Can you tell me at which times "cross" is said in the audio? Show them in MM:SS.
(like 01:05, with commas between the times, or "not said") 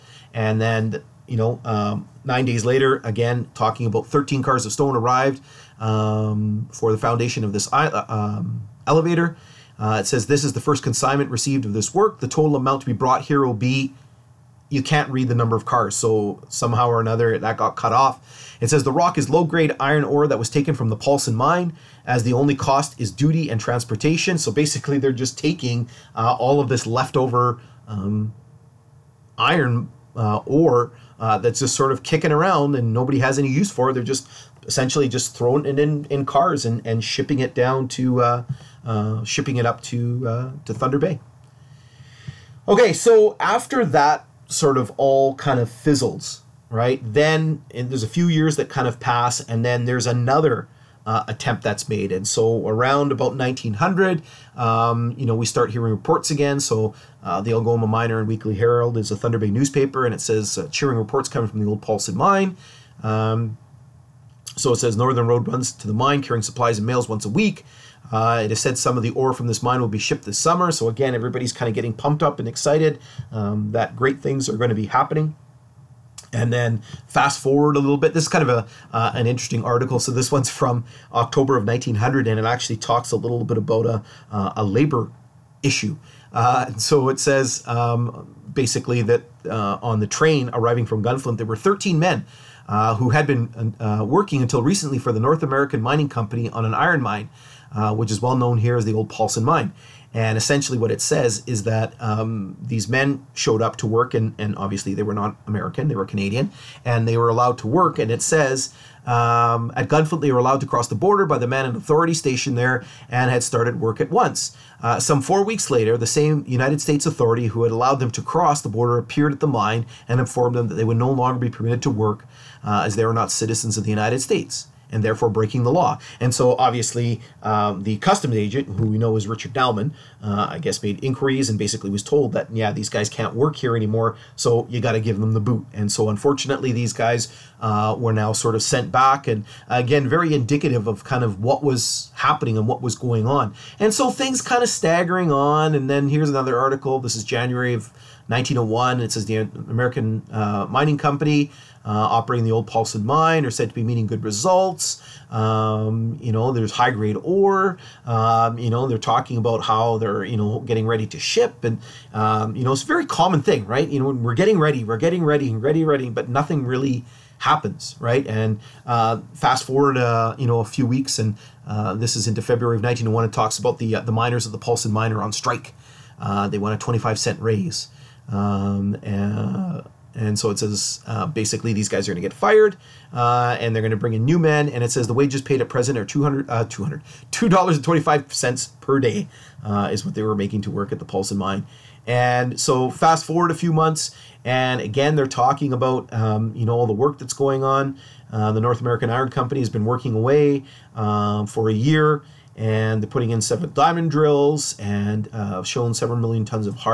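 01:50, 01:58.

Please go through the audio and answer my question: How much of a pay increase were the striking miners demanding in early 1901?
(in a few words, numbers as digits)
25 cents.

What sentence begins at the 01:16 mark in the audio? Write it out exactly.
And then fast forward a little bit.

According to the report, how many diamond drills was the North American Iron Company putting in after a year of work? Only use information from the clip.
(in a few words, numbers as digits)
7.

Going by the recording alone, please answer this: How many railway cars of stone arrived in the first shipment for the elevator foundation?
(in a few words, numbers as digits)
13.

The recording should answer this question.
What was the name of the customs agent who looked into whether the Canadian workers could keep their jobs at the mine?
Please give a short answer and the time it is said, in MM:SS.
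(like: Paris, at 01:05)
Richard Dalman, at 02:09.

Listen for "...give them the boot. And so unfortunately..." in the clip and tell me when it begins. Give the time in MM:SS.
02:14.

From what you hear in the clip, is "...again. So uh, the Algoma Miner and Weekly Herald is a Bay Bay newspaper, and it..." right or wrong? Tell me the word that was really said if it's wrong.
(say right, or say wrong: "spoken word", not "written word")
wrong: "Thunder", not "Bay".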